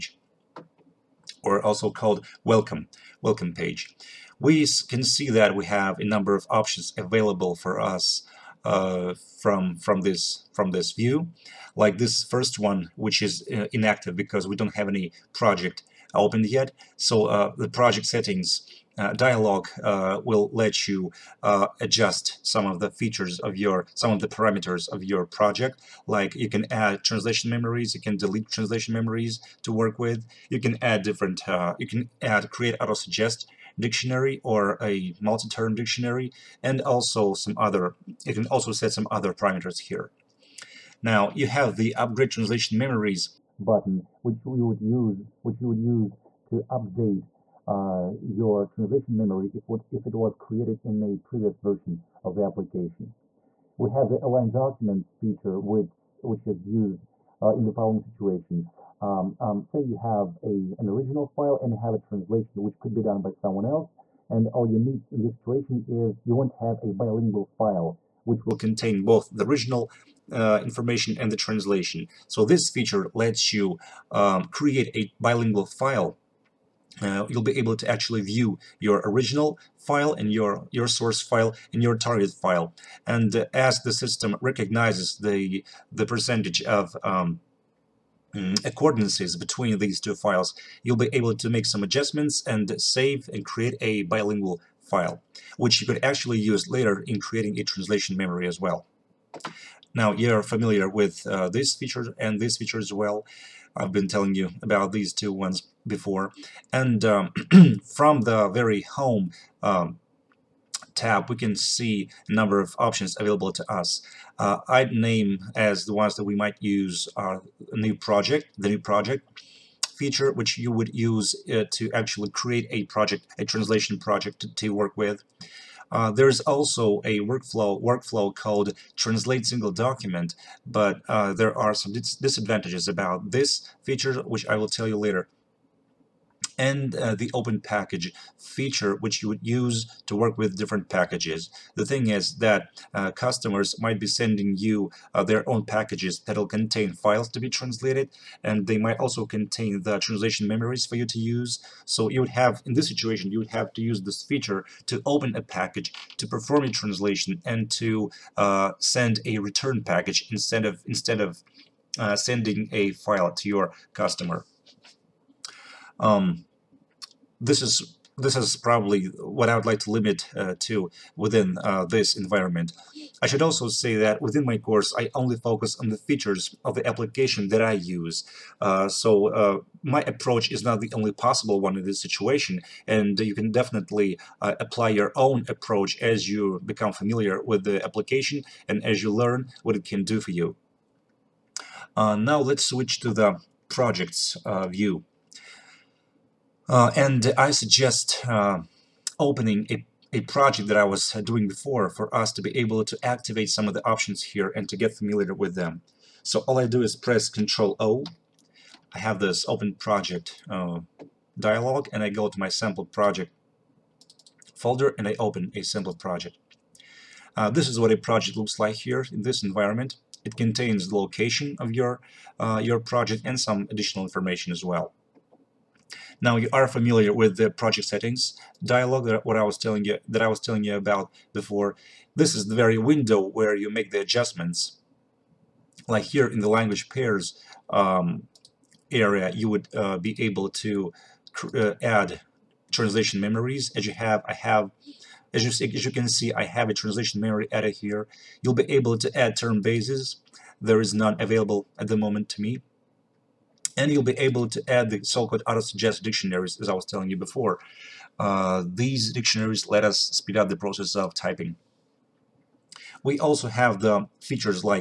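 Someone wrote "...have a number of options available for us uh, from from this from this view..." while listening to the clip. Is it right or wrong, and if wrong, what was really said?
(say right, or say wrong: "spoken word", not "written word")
right.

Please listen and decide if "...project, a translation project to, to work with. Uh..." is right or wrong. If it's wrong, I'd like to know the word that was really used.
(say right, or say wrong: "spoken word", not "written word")
right.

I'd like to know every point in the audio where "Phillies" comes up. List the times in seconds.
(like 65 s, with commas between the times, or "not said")
not said.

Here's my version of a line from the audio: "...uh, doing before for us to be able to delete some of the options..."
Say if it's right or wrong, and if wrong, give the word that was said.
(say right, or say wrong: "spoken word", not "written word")
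wrong: "activate", not "delete".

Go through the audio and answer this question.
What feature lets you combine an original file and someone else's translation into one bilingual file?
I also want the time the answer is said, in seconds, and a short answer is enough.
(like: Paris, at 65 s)
Align documents, at 54 s.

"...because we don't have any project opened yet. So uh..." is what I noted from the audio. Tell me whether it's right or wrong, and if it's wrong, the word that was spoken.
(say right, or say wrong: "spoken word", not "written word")
right.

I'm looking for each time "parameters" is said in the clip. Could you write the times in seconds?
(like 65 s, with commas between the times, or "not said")
24 s, 39 s.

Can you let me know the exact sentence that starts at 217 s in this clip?
Uh, this is what a project looks like here in this environment.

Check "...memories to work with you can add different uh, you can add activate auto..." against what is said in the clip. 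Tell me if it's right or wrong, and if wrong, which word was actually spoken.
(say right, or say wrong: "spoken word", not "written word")
wrong: "create", not "activate".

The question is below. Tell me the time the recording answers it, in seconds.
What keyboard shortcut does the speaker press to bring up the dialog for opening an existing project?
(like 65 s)
207 s.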